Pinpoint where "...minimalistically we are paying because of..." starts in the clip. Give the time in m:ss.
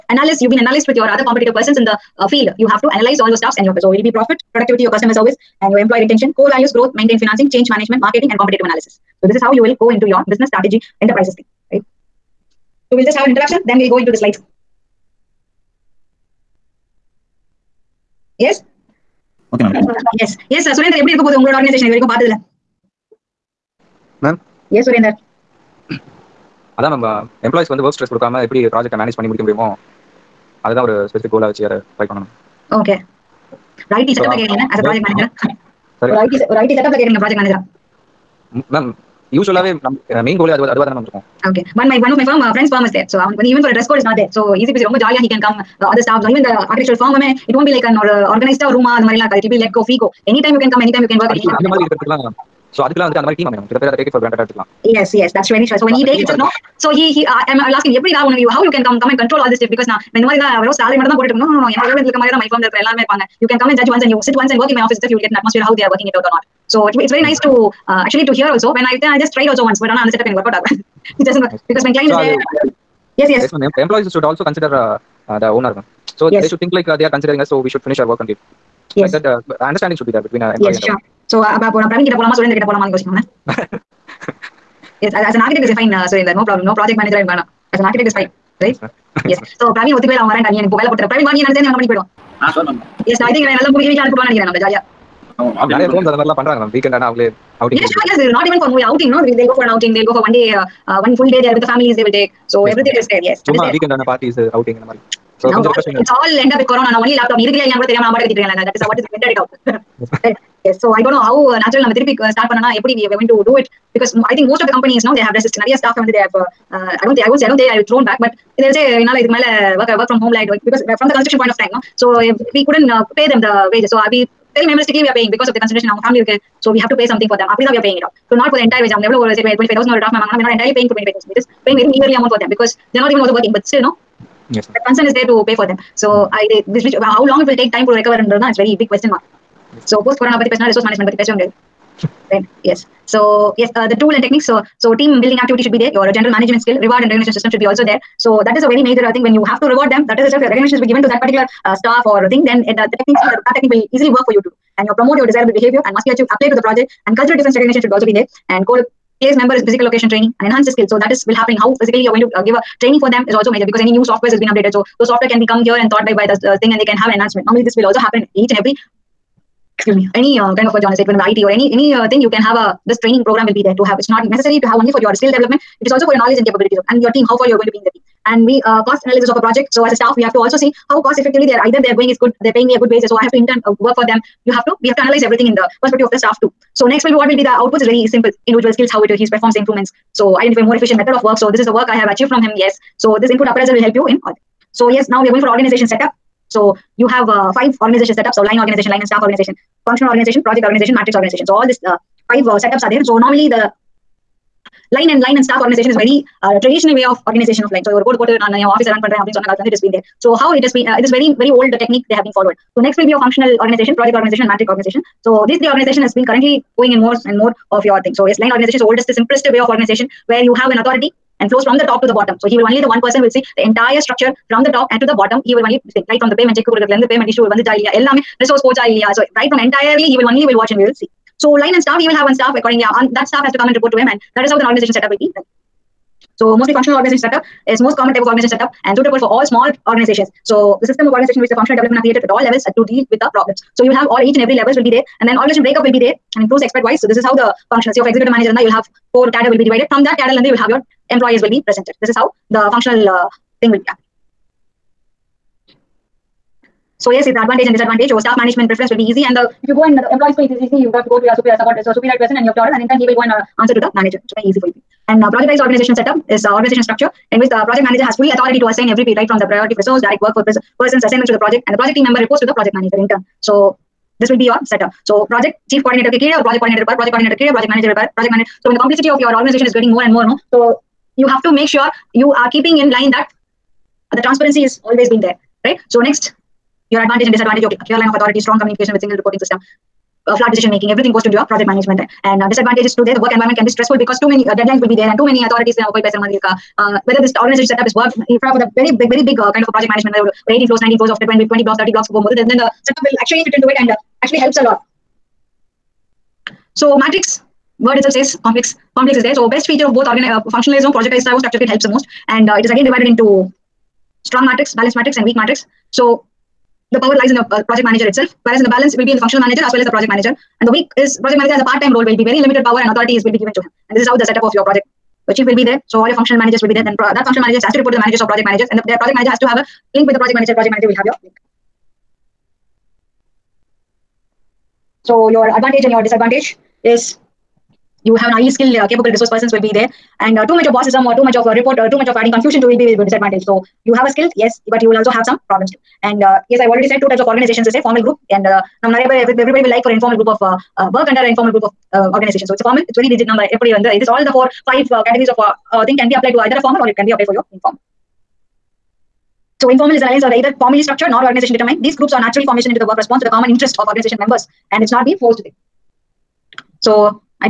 2:04.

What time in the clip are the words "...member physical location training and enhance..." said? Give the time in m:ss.
2:39.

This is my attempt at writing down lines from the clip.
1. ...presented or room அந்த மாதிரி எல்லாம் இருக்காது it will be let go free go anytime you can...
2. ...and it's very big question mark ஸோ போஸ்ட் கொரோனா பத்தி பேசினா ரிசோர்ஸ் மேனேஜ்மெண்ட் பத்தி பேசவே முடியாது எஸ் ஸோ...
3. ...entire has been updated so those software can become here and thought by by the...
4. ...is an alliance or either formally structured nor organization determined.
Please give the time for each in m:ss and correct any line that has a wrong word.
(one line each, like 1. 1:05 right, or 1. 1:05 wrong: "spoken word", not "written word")
1. 0:48 wrong: "organized", not "presented"
2. 2:18 right
3. 2:44 wrong: "software", not "entire"
4. 5:59 right.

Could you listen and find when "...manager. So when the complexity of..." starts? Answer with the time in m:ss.
4:38.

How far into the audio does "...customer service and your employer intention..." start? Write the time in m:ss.
0:04.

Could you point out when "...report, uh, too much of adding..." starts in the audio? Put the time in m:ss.
5:41.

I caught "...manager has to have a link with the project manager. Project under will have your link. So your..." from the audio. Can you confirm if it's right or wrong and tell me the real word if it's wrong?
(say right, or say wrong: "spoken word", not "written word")
wrong: "manager", not "under".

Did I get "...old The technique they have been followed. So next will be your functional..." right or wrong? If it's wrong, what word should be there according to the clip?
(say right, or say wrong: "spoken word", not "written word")
right.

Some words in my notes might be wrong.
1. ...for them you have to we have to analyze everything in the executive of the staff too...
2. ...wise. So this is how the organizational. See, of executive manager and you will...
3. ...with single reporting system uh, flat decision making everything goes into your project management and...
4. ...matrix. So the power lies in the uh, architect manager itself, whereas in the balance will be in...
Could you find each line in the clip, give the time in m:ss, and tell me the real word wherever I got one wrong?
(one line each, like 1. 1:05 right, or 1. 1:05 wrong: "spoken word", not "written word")
1. 3:03 wrong: "perspective", not "executive"
2. 4:06 wrong: "functional", not "organizational"
3. 4:48 right
4. 5:15 wrong: "project", not "architect".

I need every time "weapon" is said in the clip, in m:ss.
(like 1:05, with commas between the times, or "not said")
not said.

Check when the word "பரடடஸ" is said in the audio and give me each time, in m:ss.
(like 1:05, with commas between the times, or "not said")
1:44.